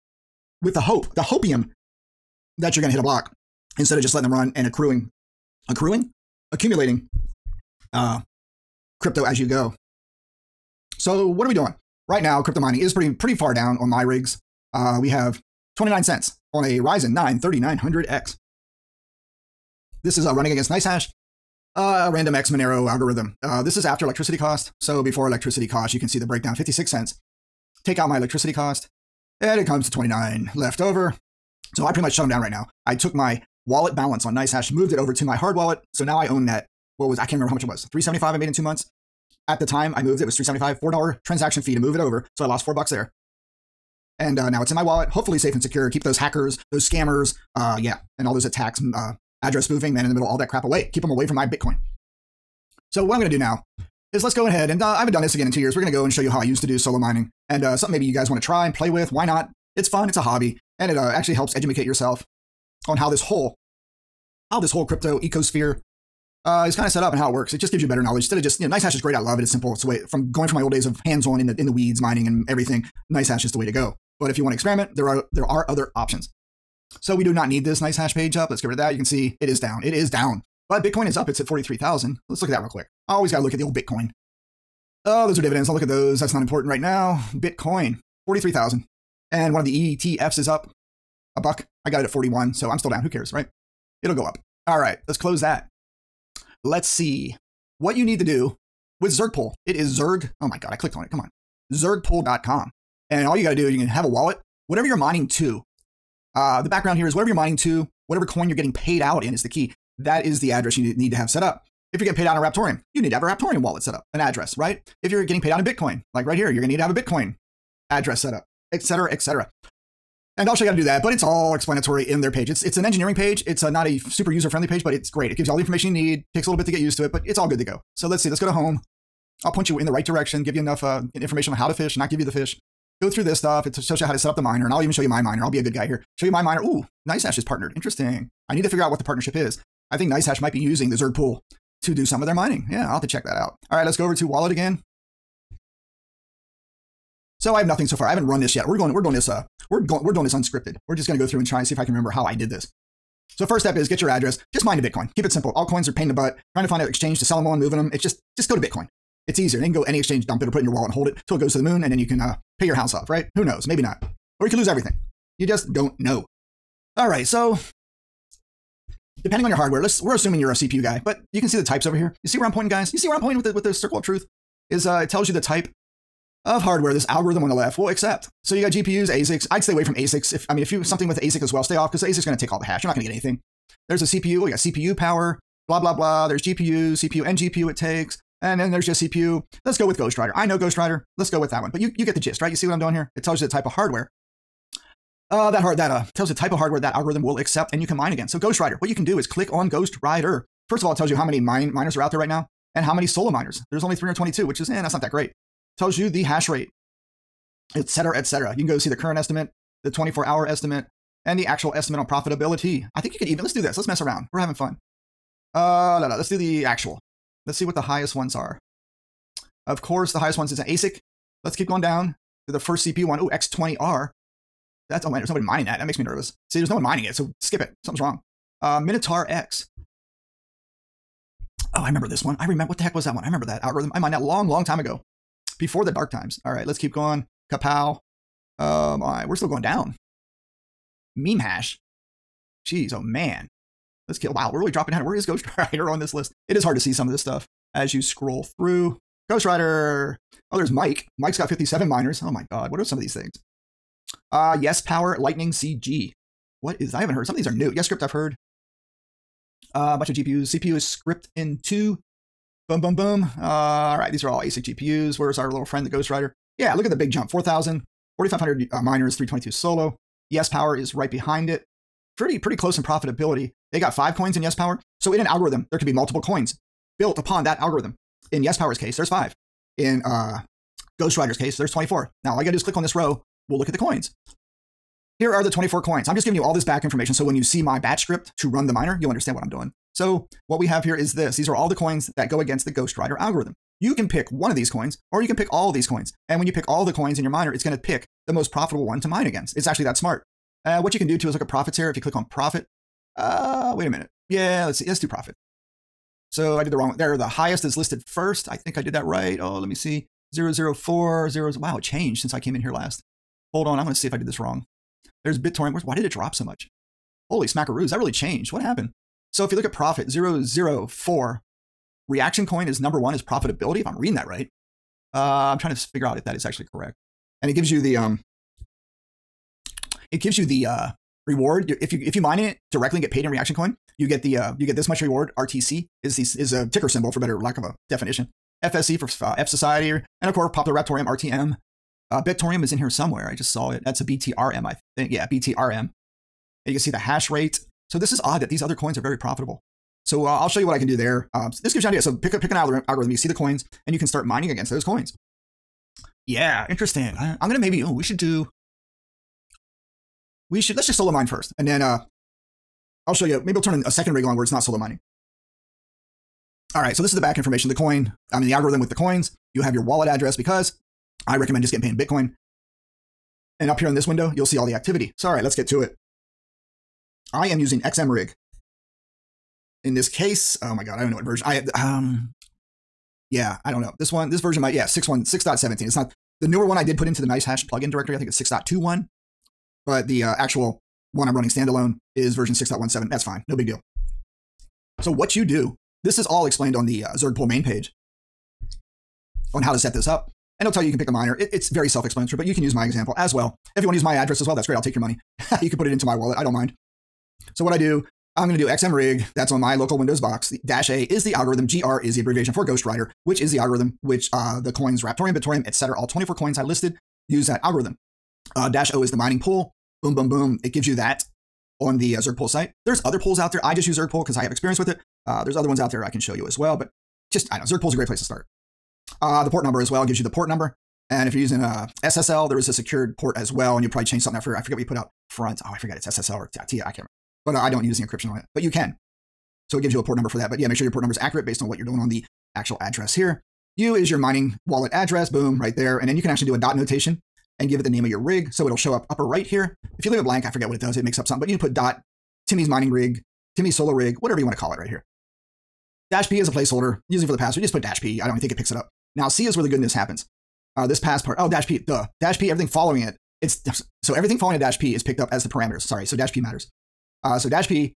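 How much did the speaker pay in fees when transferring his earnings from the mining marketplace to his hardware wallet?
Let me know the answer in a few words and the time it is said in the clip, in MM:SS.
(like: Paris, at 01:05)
$4, at 00:40.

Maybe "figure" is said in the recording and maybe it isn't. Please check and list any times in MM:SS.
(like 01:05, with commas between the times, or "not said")
02:18, 05:25.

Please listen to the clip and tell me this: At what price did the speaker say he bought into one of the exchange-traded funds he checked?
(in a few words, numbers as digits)
41.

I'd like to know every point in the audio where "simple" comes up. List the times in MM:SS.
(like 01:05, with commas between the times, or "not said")
01:09, 02:35.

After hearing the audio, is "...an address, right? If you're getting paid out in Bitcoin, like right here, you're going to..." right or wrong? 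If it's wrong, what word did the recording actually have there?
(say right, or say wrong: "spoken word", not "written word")
right.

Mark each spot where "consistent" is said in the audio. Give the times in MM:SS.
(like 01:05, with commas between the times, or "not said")
not said.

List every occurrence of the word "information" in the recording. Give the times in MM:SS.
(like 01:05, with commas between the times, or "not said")
02:05, 02:11, 04:46, 06:07.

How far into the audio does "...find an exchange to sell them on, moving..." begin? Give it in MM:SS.
02:36.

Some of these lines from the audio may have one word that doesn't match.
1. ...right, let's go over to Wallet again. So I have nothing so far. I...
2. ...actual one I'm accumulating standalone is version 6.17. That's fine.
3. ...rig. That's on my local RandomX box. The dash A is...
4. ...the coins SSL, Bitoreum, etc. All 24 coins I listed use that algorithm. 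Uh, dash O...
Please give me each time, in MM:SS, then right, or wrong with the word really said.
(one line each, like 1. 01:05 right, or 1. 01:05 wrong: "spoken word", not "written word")
1. 02:23 right
2. 06:30 wrong: "running", not "accumulating"
3. 06:48 wrong: "Windows", not "RandomX"
4. 06:54 wrong: "Raptoreum", not "SSL".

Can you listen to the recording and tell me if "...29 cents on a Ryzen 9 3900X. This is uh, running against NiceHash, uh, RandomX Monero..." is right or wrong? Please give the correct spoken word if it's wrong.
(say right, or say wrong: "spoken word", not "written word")
right.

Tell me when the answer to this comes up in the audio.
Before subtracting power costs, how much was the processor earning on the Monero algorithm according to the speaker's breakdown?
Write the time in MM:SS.
00:26.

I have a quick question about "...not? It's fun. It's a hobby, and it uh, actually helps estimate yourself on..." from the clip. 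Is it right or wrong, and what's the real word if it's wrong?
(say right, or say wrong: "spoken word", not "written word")
wrong: "educate", not "estimate".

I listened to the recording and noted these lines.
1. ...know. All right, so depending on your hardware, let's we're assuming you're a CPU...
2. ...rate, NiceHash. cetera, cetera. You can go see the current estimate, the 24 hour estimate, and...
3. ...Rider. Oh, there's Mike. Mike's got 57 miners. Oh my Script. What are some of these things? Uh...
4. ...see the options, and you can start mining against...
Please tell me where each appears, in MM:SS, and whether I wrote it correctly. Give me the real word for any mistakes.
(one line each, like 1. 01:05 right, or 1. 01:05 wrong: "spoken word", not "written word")
1. 02:45 right
2. 03:26 wrong: "Etc", not "NiceHash"
3. 04:09 wrong: "God", not "Script"
4. 05:53 wrong: "coins", not "options".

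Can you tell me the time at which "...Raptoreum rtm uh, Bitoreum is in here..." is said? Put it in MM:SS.
05:40.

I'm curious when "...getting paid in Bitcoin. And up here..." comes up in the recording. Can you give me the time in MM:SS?
06:11.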